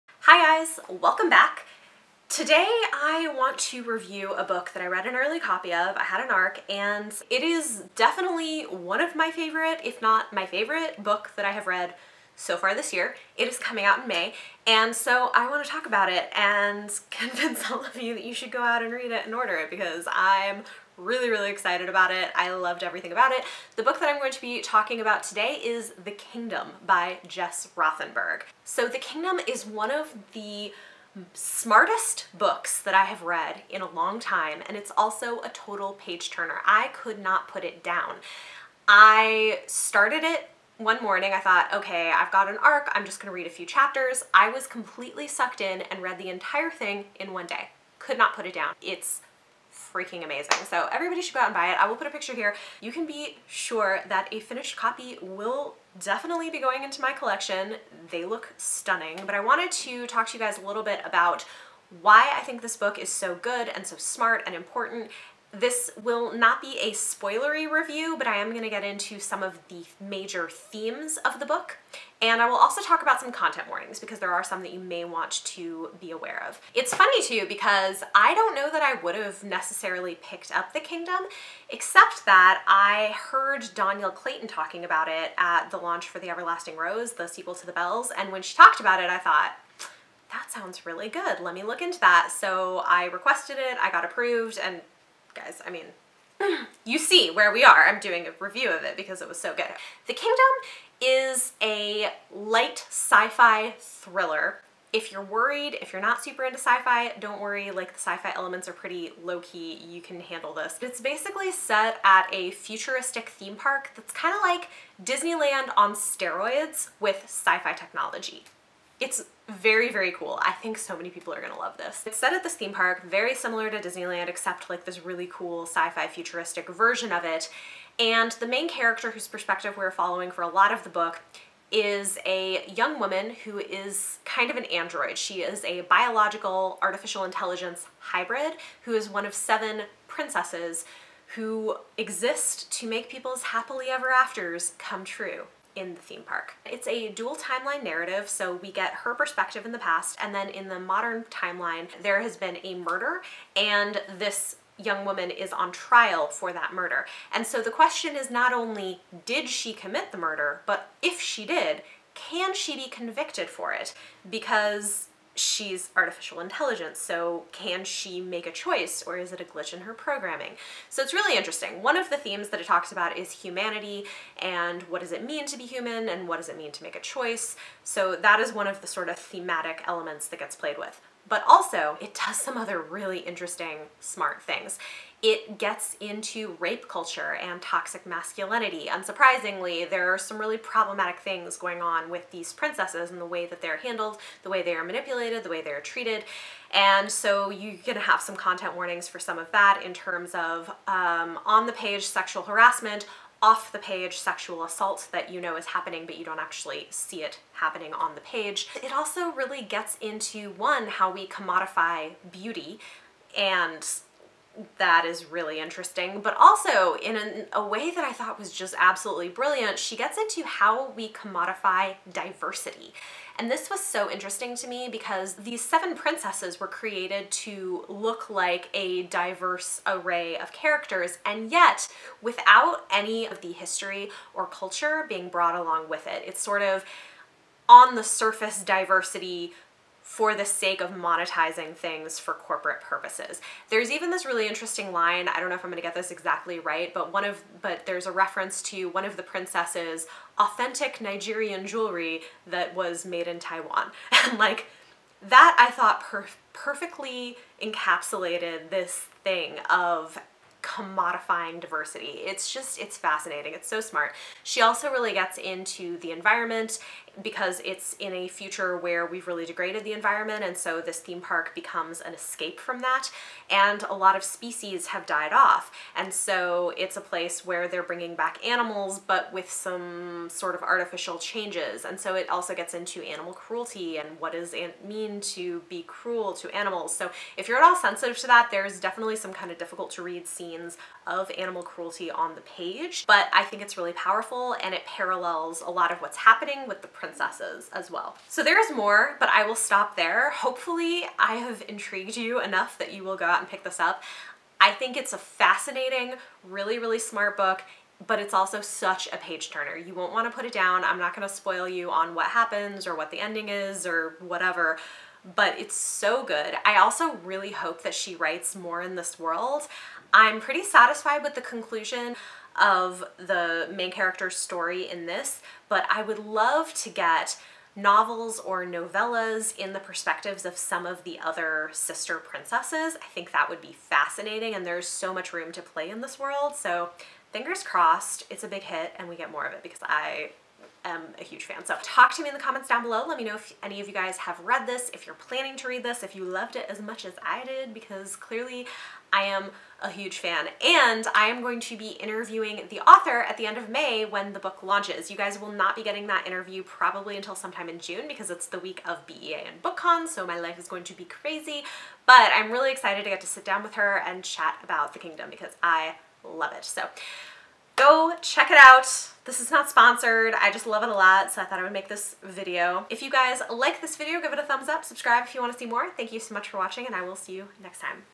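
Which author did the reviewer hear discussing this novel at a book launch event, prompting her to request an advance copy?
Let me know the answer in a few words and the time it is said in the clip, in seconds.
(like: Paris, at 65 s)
Dhonielle Clayton, at 83 s.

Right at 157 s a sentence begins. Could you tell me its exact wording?
And so the question is not only did she commit the murder, but if she did, can she be convicted for it?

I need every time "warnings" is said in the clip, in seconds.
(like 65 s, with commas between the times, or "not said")
73 s, 198 s.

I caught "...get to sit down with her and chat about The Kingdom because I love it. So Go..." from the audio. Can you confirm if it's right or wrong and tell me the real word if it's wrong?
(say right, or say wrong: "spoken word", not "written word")
right.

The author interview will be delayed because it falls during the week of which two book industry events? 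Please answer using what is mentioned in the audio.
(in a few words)
BEA and BookCon.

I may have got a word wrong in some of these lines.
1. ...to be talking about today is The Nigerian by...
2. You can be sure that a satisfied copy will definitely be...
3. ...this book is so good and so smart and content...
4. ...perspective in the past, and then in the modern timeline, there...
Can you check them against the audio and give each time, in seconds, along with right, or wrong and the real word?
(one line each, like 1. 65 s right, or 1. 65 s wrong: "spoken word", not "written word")
1. 24 s wrong: "Kingdom", not "Nigerian"
2. 52 s wrong: "finished", not "satisfied"
3. 62 s wrong: "important", not "content"
4. 149 s right.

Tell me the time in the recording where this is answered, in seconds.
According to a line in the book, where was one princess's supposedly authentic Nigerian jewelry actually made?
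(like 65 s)
253 s.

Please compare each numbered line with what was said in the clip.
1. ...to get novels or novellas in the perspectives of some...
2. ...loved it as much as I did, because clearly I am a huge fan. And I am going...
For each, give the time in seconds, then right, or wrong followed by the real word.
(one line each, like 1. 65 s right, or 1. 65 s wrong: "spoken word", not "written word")
1. 326 s right
2. 346 s right.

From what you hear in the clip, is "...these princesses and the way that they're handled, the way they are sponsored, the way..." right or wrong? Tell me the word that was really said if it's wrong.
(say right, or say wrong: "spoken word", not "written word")
wrong: "manipulated", not "sponsored".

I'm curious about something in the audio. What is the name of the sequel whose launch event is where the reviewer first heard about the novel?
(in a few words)
The Everlasting Rose.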